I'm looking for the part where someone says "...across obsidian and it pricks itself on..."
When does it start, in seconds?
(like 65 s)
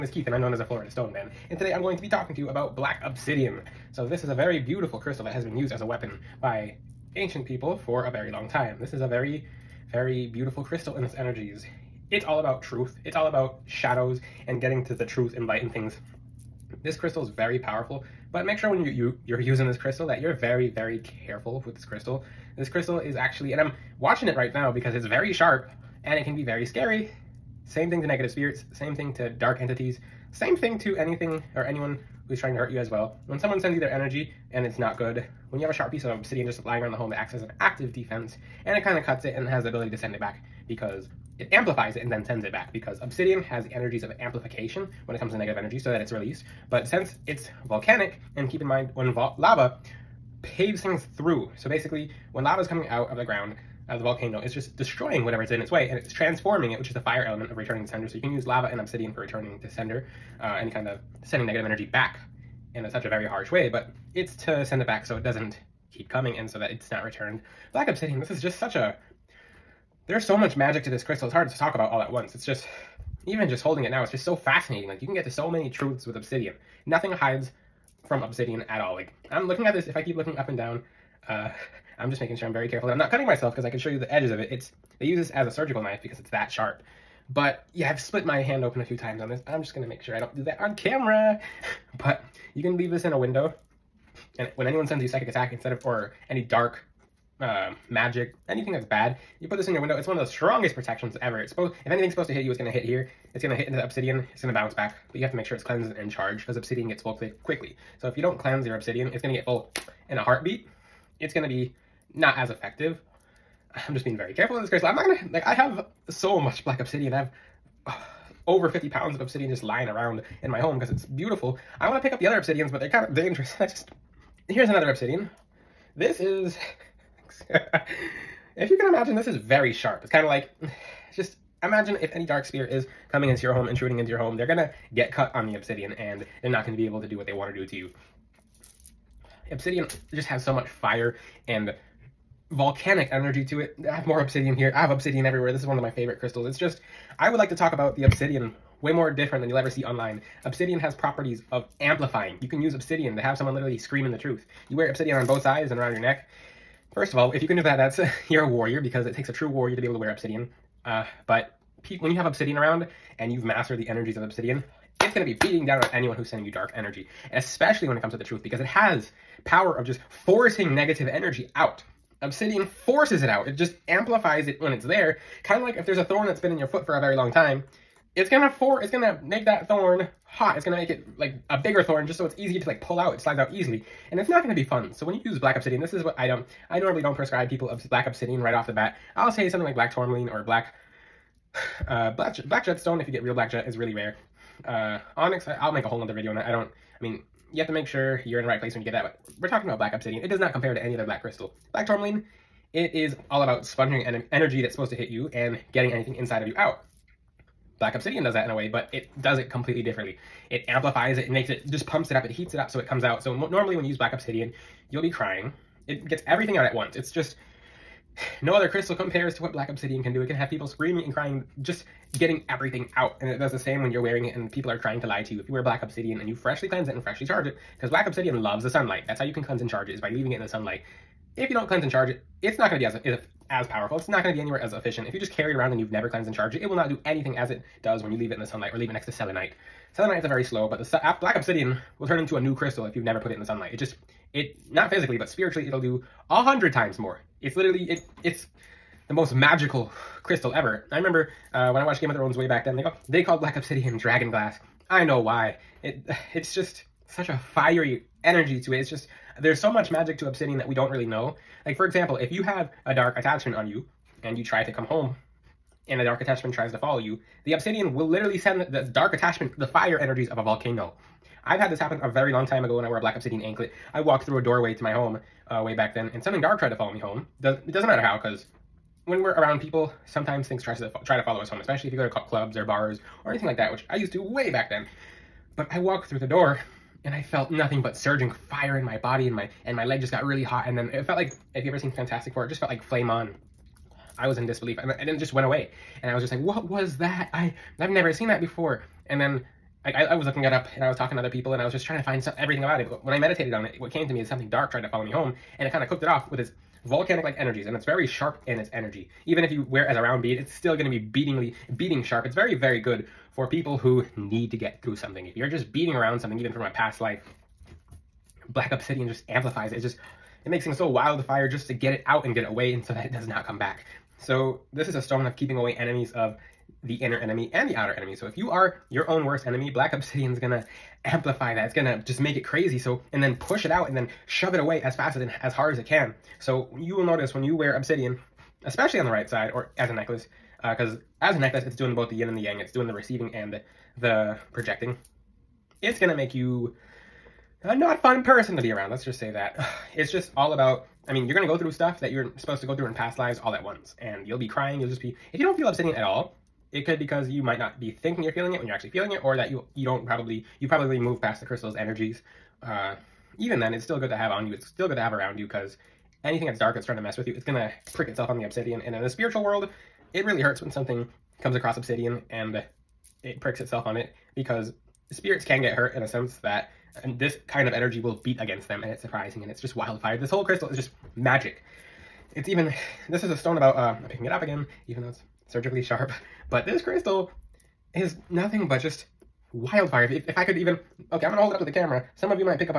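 371 s.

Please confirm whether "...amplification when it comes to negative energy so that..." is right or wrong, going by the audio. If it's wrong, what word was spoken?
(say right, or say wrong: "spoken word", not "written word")
right.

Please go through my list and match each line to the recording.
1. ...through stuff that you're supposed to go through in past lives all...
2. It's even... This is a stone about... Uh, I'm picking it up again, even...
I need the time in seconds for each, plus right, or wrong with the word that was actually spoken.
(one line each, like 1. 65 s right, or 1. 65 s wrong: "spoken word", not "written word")
1. 351 s right
2. 382 s right.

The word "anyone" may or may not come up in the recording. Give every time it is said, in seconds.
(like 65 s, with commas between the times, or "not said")
31 s, 94 s, 165 s.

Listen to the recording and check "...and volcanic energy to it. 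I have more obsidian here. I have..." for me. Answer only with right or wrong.
right.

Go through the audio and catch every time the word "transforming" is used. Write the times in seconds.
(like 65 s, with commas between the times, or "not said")
56 s.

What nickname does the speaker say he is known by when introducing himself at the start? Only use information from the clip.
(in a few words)
Florida Stone Man.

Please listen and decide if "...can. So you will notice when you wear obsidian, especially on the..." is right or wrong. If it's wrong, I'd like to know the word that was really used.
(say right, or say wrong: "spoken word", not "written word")
right.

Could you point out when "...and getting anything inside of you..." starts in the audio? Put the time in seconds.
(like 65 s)
205 s.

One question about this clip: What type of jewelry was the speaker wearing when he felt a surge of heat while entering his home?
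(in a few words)
Black obsidian anklet.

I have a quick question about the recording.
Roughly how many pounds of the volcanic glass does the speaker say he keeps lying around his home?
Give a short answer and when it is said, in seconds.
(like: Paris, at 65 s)
Over 50 pounds, at 118 s.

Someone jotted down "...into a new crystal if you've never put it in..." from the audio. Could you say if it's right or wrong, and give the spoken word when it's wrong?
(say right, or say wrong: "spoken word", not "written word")
right.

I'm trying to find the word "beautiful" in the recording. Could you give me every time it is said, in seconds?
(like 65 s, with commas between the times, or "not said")
4 s, 10 s, 121 s.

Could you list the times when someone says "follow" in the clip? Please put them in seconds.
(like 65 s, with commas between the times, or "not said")
266 s, 276 s, 281 s, 304 s.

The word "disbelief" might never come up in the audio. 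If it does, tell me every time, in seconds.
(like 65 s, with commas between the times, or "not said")
294 s.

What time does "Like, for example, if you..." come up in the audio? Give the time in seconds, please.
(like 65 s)
261 s.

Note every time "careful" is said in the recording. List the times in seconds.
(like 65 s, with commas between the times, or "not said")
21 s, 82 s, 114 s.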